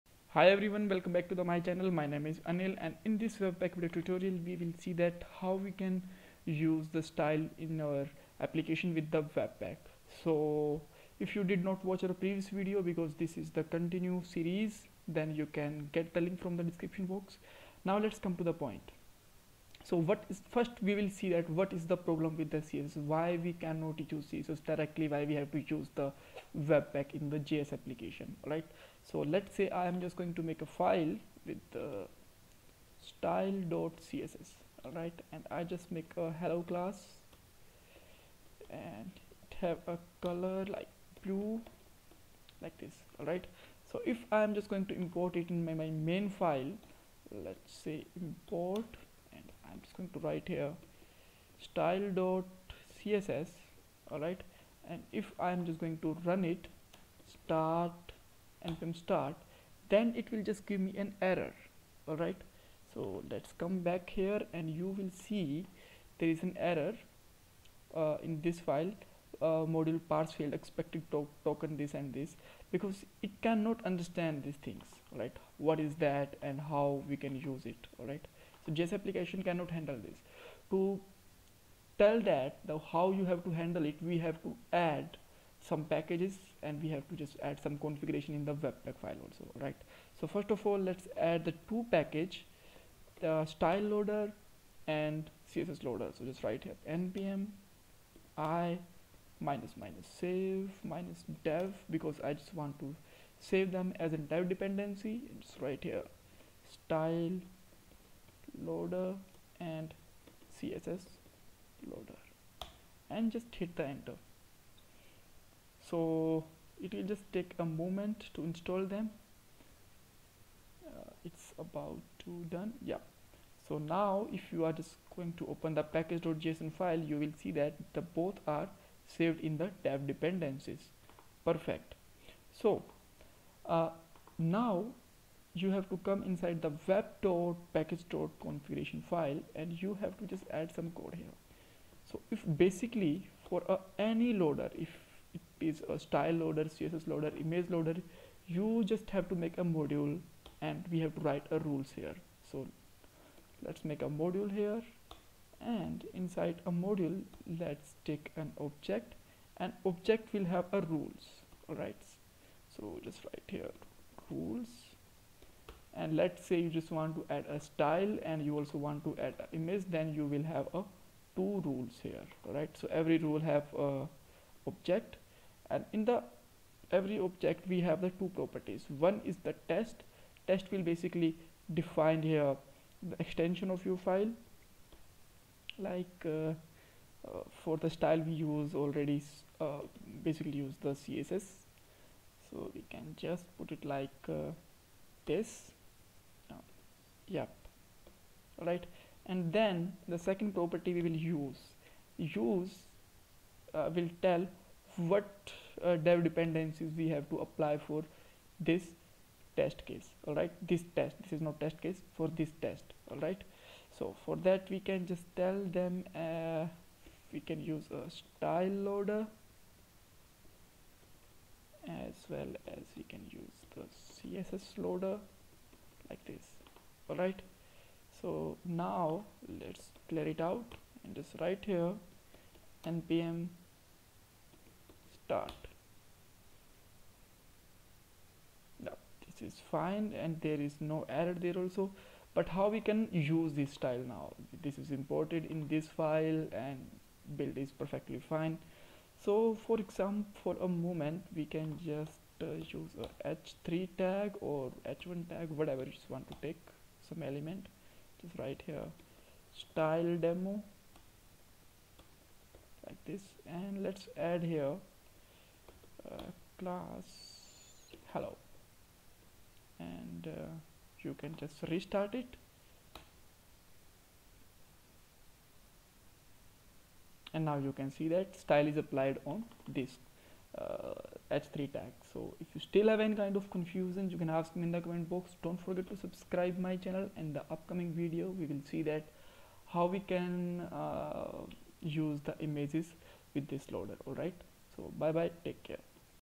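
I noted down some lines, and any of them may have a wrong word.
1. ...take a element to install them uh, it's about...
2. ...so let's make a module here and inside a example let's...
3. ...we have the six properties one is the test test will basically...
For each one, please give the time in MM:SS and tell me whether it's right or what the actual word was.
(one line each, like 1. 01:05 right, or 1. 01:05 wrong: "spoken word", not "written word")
1. 01:57 wrong: "moment", not "element"
2. 02:32 wrong: "module", not "example"
3. 02:57 wrong: "two", not "six".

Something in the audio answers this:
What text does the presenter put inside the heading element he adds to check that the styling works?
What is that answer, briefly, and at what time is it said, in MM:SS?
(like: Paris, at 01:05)
style demo, at 04:19.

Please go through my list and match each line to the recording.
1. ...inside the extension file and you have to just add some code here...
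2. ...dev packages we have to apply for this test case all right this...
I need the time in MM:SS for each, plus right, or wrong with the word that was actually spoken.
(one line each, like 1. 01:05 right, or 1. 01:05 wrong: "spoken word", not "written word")
1. 02:16 wrong: "configuration", not "extension"
2. 03:25 wrong: "dependencies", not "packages".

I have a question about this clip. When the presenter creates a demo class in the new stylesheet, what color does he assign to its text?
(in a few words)
blue.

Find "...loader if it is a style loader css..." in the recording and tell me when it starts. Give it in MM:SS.
02:24.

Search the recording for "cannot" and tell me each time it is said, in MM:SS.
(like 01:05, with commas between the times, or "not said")
00:23, 01:13, 01:19.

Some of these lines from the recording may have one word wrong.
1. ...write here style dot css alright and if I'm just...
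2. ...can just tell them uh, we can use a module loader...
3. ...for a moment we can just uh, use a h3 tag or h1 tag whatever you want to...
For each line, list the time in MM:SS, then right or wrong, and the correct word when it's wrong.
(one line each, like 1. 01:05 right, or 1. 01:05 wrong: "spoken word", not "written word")
1. 00:50 right
2. 03:34 wrong: "style", not "module"
3. 04:10 right.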